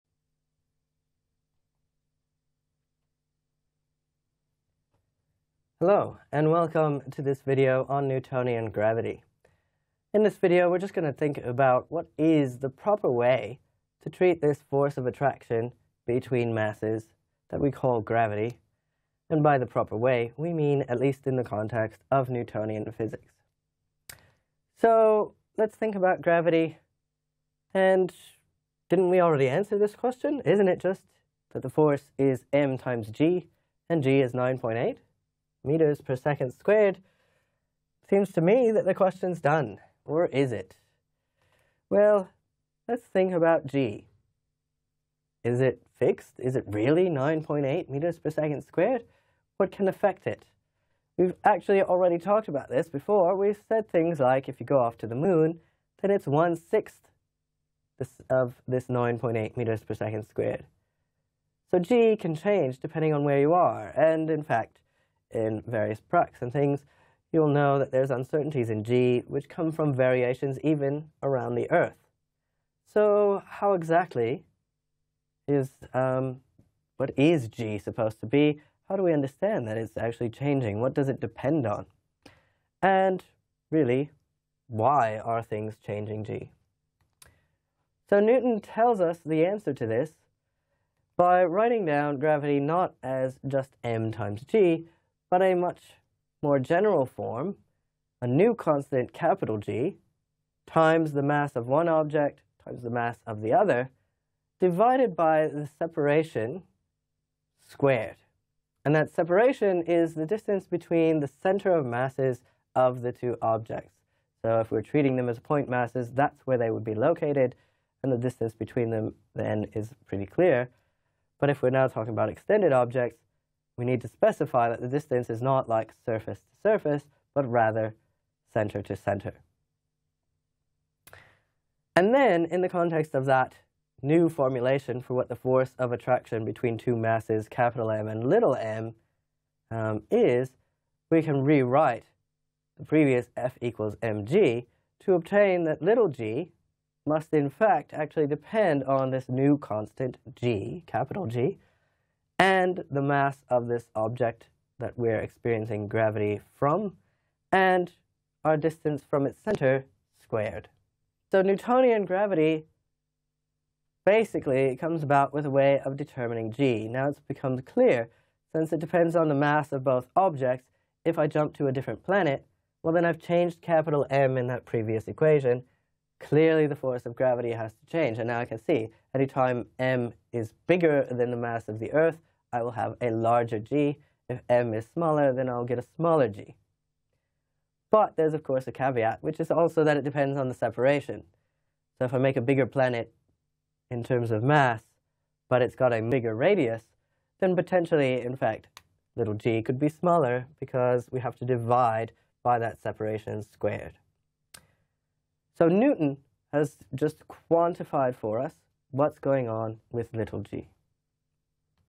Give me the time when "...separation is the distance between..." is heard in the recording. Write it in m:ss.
1:49.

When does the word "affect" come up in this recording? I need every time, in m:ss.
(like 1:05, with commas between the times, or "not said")
0:49.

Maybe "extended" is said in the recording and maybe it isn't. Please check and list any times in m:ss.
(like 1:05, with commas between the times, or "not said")
2:02.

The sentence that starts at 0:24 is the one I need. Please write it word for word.
So let's think about gravity, and didn't we already answer this question?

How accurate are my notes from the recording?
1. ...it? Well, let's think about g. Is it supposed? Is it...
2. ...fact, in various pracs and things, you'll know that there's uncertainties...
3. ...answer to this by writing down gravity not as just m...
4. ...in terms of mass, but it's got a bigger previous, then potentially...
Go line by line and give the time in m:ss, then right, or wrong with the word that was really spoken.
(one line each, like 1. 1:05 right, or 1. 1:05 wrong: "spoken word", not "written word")
1. 0:40 wrong: "fixed", not "supposed"
2. 1:04 right
3. 1:29 right
4. 3:13 wrong: "radius", not "previous".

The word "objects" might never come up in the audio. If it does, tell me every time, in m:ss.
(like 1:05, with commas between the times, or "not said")
1:41, 1:53, 2:02, 2:33, 2:50.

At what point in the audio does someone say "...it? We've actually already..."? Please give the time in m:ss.
0:50.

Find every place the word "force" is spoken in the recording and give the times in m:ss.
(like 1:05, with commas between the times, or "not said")
0:14, 0:31, 2:15, 2:56.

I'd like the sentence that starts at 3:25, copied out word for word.
So Newton has just quantified for us what's going on with little g.